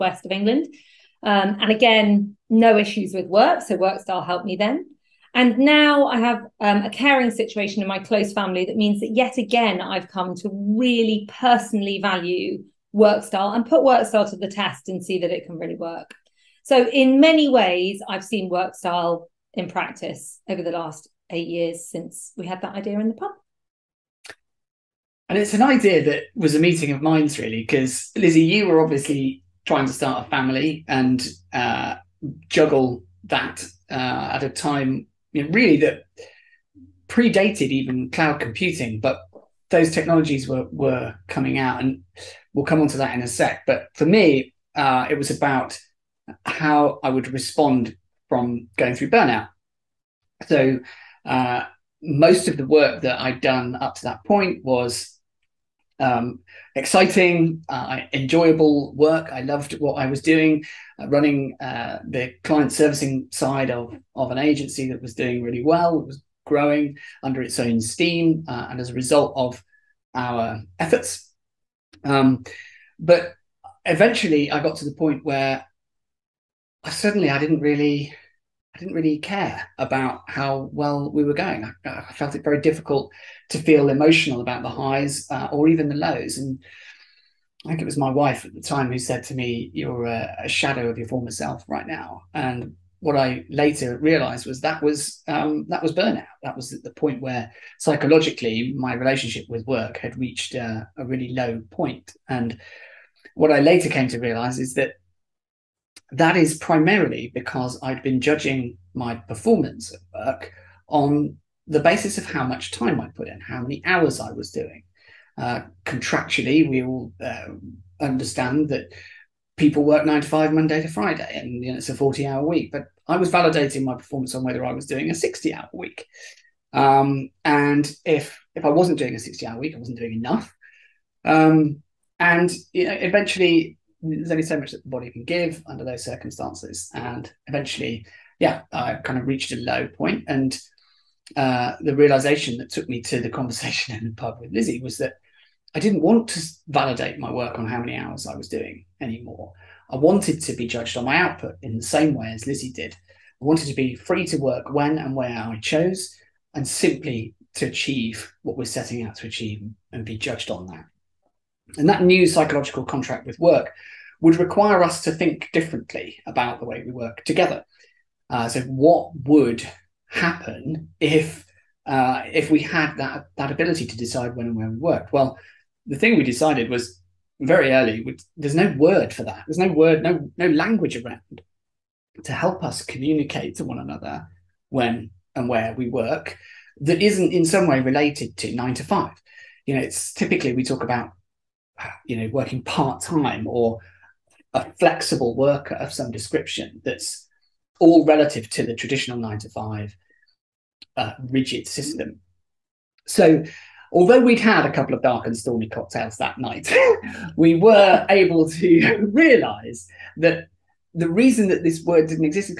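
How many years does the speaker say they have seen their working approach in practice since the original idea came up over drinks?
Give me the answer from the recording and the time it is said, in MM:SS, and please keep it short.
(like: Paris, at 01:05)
8, at 00:21.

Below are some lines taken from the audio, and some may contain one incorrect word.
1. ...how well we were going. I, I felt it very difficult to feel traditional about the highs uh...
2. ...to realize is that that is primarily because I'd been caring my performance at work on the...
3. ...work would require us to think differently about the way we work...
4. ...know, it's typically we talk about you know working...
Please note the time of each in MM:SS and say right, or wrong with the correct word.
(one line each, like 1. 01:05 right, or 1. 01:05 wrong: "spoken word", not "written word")
1. 01:20 wrong: "emotional", not "traditional"
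2. 01:44 wrong: "judging", not "caring"
3. 02:43 right
4. 03:09 right.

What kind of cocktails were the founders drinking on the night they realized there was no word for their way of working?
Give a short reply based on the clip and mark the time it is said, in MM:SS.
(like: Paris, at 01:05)
dark and stormy, at 03:25.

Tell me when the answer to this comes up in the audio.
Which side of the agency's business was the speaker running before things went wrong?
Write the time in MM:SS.
01:02.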